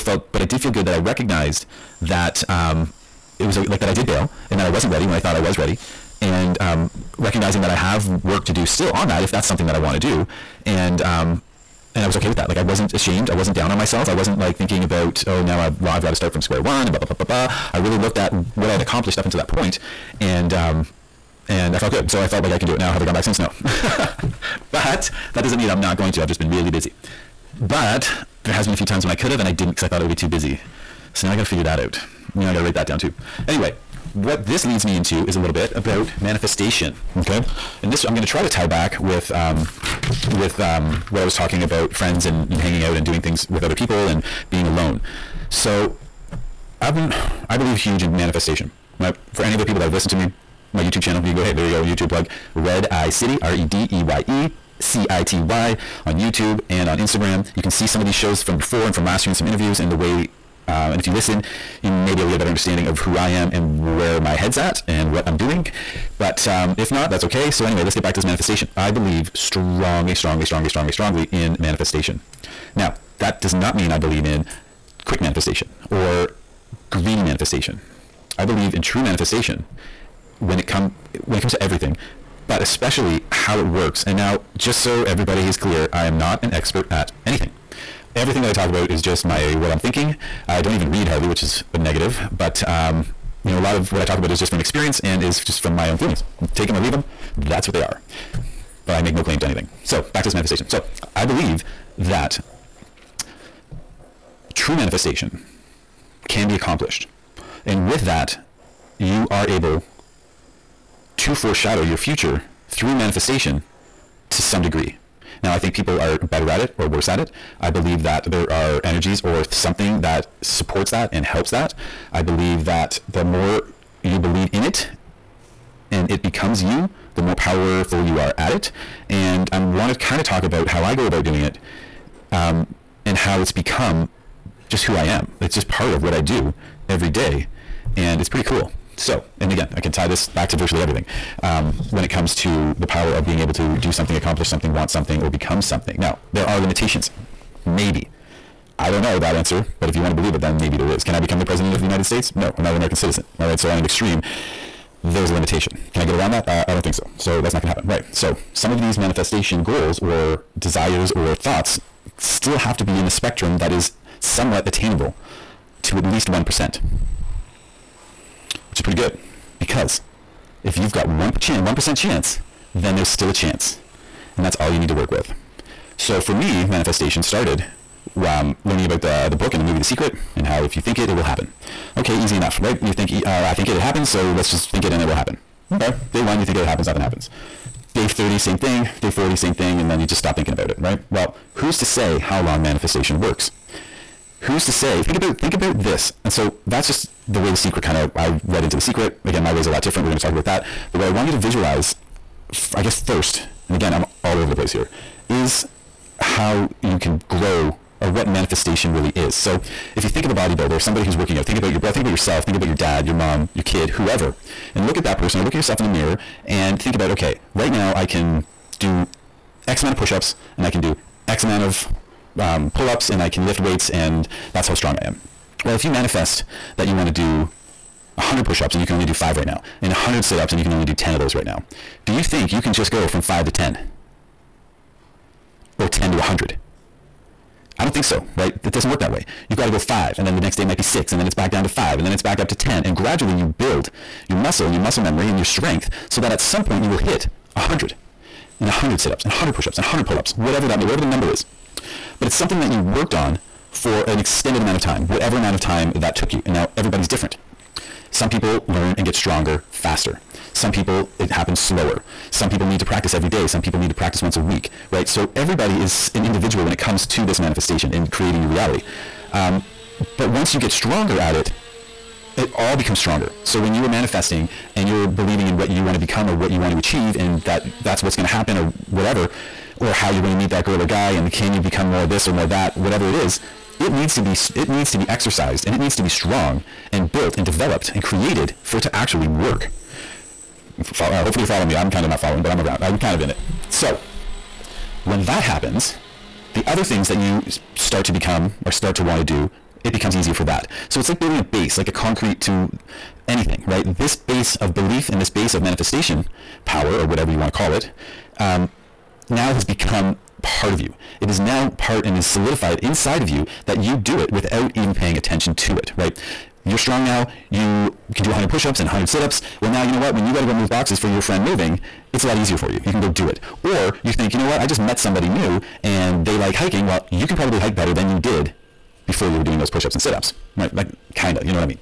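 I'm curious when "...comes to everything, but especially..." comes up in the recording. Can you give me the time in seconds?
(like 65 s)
81 s.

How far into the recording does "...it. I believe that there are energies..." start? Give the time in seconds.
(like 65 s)
117 s.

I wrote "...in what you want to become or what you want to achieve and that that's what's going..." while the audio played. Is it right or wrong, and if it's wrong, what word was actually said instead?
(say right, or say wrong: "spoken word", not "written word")
right.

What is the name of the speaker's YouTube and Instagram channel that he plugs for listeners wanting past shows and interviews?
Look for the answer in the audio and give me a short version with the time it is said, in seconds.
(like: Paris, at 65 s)
Redeye City, at 52 s.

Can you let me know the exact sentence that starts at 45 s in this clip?
So I've been, I believe huge in manifestation.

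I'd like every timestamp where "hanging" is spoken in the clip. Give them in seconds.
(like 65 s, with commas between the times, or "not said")
42 s.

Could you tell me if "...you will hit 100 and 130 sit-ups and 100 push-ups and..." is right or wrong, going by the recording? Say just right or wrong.
wrong.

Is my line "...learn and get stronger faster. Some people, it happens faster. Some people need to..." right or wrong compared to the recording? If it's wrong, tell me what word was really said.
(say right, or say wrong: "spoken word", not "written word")
wrong: "slower", not "faster".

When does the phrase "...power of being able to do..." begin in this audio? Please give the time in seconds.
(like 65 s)
142 s.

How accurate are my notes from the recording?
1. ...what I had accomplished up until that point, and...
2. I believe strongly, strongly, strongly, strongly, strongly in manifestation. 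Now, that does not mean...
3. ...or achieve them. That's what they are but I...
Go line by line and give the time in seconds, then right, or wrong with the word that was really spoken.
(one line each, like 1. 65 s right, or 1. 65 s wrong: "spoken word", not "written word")
1. 18 s right
2. 68 s right
3. 96 s wrong: "leave", not "achieve".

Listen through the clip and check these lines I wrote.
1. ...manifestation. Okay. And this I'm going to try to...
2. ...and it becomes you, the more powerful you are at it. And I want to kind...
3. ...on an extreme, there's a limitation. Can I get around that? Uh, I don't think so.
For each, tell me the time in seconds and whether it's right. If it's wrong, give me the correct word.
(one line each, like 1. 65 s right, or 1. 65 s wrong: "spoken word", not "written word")
1. 36 s right
2. 125 s right
3. 153 s right.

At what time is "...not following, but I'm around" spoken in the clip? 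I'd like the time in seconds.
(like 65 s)
292 s.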